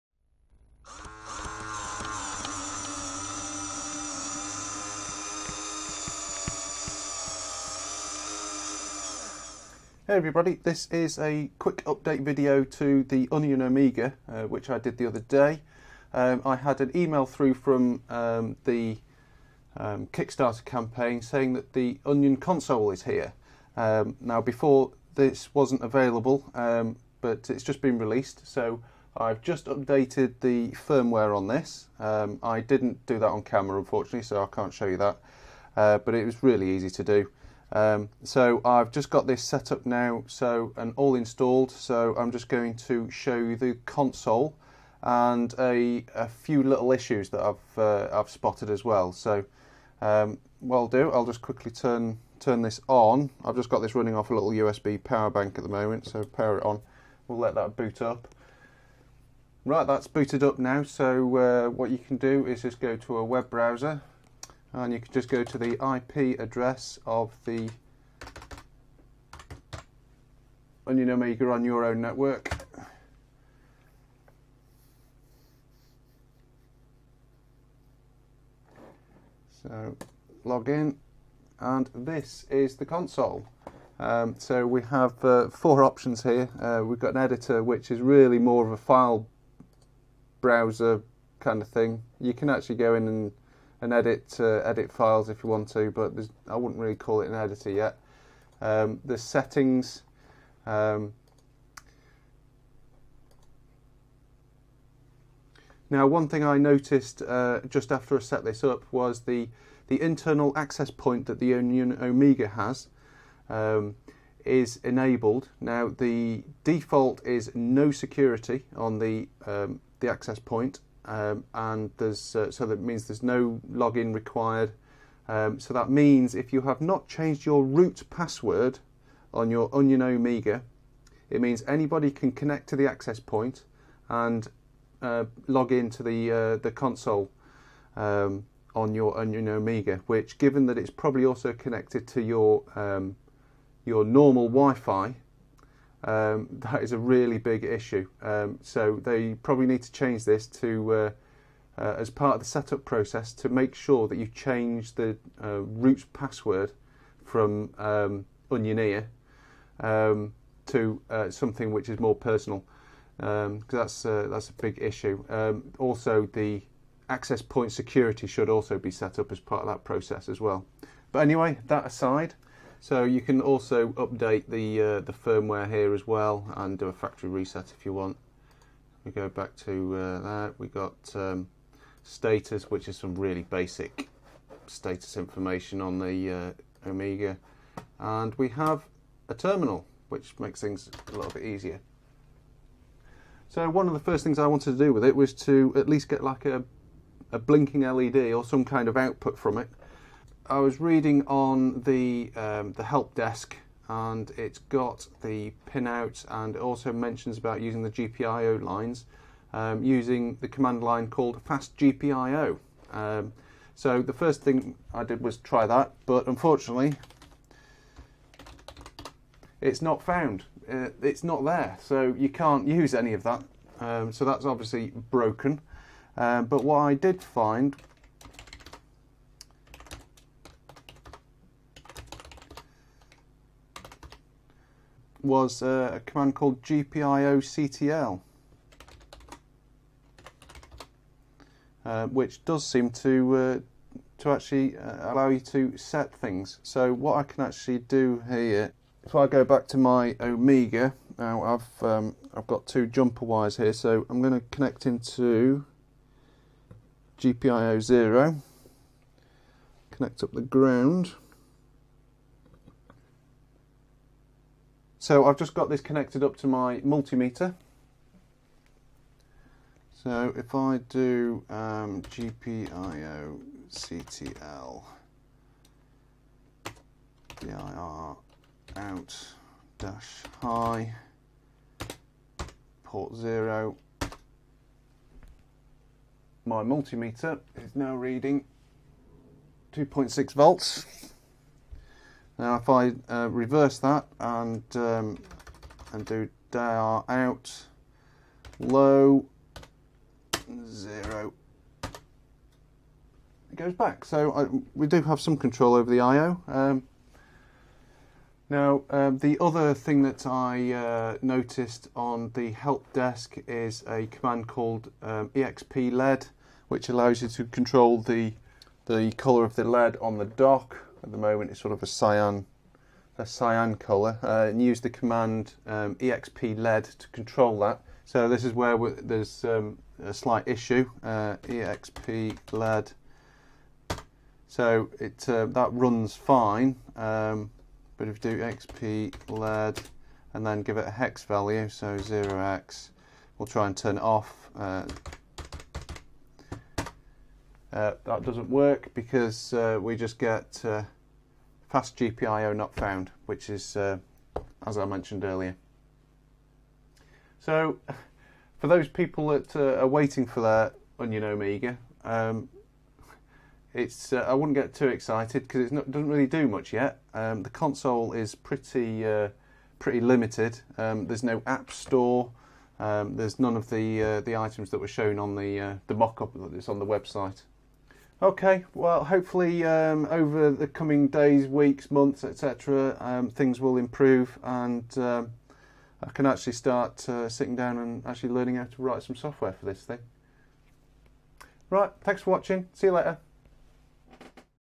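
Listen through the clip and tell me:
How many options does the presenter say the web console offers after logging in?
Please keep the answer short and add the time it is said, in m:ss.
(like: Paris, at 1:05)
4, at 1:25.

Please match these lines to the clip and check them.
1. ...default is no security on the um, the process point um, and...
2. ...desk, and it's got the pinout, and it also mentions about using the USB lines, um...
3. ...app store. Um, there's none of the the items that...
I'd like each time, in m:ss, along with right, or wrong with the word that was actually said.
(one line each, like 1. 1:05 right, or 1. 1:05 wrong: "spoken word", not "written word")
1. 1:56 wrong: "access", not "process"
2. 3:23 wrong: "GPIO", not "USB"
3. 6:11 right.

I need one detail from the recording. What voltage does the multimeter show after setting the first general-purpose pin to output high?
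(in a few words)
2.6 volts.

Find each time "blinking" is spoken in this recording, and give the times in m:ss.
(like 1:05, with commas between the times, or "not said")
3:17.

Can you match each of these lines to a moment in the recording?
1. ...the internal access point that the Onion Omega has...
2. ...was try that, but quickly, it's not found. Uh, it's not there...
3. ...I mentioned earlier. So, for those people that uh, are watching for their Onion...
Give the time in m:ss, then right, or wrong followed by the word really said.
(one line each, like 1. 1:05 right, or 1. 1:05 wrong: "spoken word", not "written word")
1. 1:49 right
2. 3:35 wrong: "unfortunately", not "quickly"
3. 5:54 wrong: "waiting", not "watching".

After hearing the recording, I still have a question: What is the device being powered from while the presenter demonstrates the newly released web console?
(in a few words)
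USB power bank.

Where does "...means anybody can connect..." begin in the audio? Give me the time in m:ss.
2:11.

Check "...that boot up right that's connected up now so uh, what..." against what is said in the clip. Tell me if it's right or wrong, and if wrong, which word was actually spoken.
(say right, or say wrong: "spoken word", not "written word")
wrong: "booted", not "connected".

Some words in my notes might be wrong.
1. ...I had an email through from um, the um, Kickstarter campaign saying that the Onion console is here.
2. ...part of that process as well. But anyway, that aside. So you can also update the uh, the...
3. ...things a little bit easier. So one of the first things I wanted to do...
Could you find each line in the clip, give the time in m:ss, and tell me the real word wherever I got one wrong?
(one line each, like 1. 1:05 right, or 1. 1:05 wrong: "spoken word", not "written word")
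1. 0:16 right
2. 2:49 right
3. 3:10 right.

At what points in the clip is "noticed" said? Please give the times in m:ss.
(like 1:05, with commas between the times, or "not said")
1:46, 5:11.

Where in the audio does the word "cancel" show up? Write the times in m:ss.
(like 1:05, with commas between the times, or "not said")
not said.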